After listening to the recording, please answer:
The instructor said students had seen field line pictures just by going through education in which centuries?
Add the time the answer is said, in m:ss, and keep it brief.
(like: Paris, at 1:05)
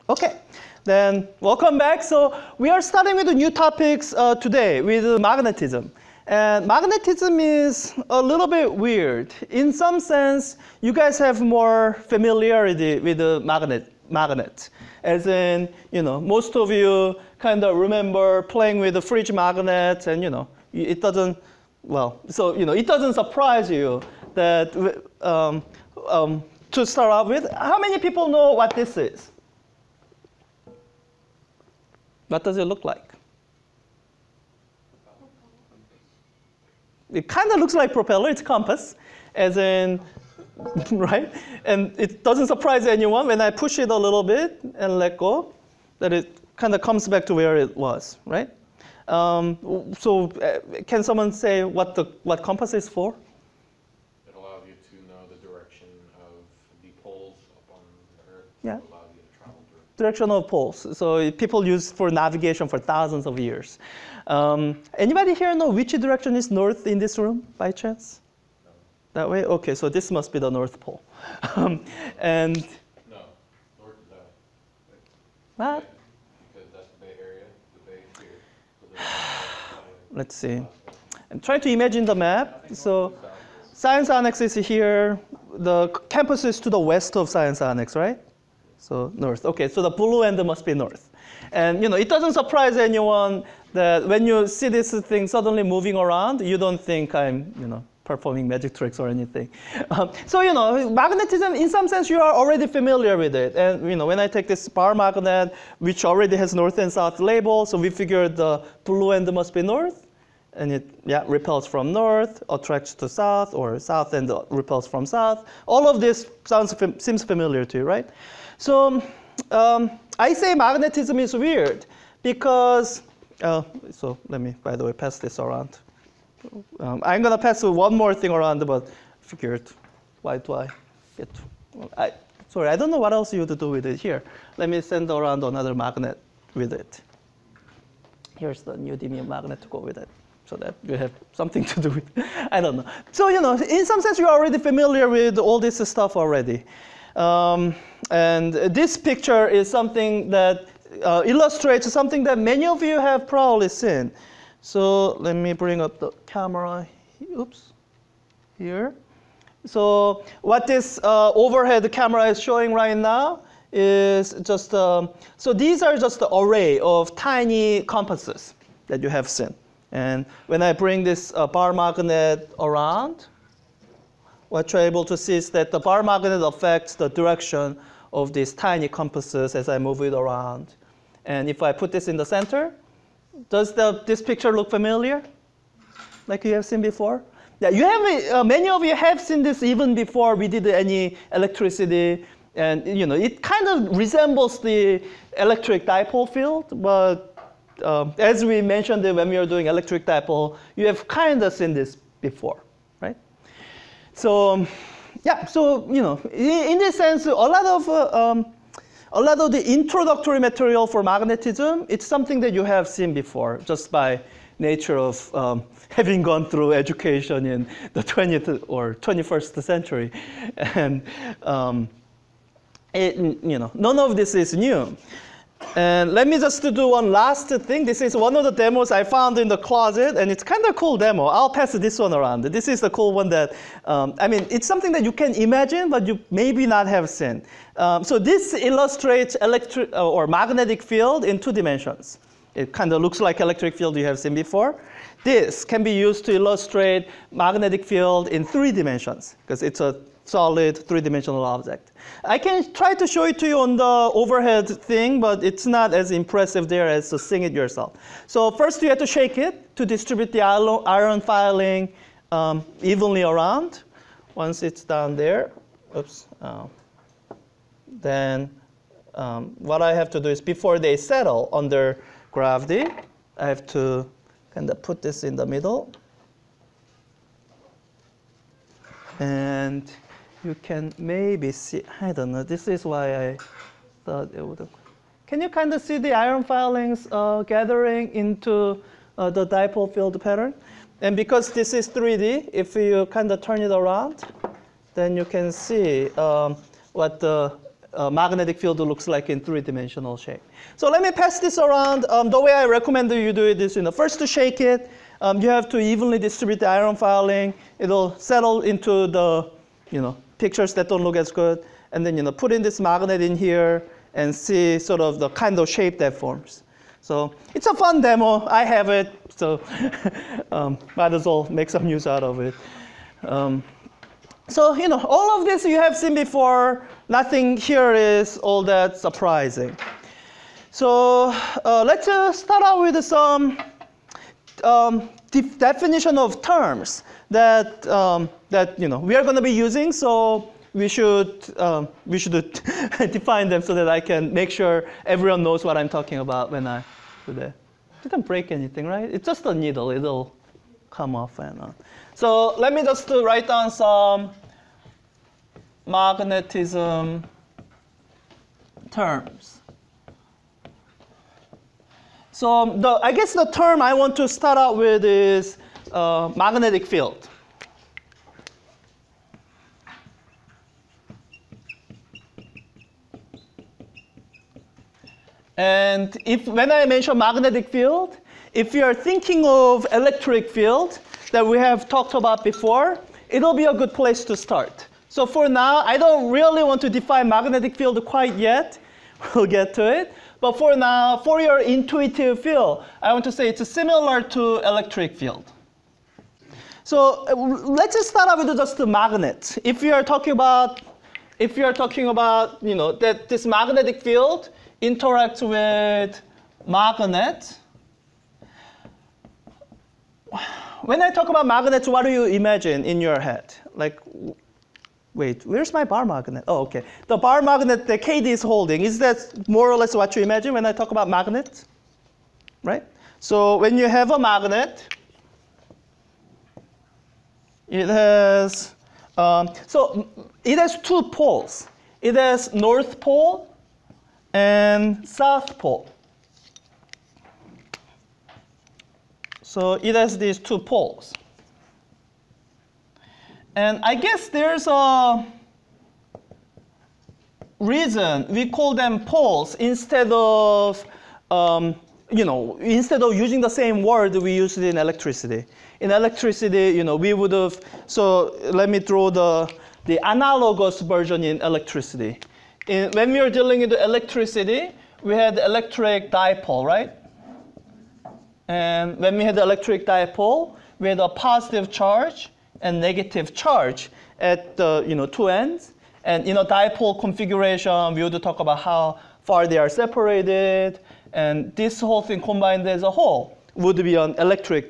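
20th or 21st century, at 3:38.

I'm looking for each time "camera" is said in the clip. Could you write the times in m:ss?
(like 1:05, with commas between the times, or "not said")
2:36, 2:41.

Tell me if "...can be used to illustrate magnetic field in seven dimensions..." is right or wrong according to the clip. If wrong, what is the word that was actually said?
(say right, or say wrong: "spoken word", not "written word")
wrong: "three", not "seven".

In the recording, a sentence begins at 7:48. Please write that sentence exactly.
And when we had the electric dipole, we had a positive charge and negative charge at the you know, two ends.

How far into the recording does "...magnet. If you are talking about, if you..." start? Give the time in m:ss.
6:38.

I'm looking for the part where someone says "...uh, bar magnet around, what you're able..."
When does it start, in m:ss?
2:51.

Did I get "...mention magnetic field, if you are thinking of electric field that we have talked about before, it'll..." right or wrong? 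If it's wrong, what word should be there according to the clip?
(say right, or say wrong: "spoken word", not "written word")
right.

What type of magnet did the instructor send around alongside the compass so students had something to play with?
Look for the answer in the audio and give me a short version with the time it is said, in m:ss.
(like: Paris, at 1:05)
Neodymium magnet, at 2:18.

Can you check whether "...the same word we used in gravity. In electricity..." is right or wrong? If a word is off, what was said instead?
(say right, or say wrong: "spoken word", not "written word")
wrong: "electricity", not "gravity".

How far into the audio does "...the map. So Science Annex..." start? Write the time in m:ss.
1:22.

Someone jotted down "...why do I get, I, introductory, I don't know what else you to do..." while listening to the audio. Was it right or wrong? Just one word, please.
wrong.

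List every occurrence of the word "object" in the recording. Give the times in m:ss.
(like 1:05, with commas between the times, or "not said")
4:11.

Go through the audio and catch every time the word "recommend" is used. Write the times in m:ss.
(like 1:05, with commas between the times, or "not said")
5:02.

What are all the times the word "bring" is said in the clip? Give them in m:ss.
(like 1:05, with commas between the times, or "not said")
2:35, 2:50.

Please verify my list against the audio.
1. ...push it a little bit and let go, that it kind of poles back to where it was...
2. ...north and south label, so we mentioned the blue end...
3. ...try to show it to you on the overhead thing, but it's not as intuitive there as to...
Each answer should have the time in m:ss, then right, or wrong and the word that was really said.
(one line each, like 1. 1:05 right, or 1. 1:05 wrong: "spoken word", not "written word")
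1. 0:43 wrong: "comes", not "poles"
2. 1:46 wrong: "figured", not "mentioned"
3. 4:12 wrong: "impressive", not "intuitive".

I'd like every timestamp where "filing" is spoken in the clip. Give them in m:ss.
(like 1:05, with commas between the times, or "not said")
4:21, 4:46, 5:06.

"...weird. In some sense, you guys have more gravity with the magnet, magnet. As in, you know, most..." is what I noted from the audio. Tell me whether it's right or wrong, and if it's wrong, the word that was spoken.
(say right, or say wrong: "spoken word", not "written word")
wrong: "familiarity", not "gravity".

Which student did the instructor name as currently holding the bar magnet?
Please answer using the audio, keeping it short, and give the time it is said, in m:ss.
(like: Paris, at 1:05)
KD, at 6:58.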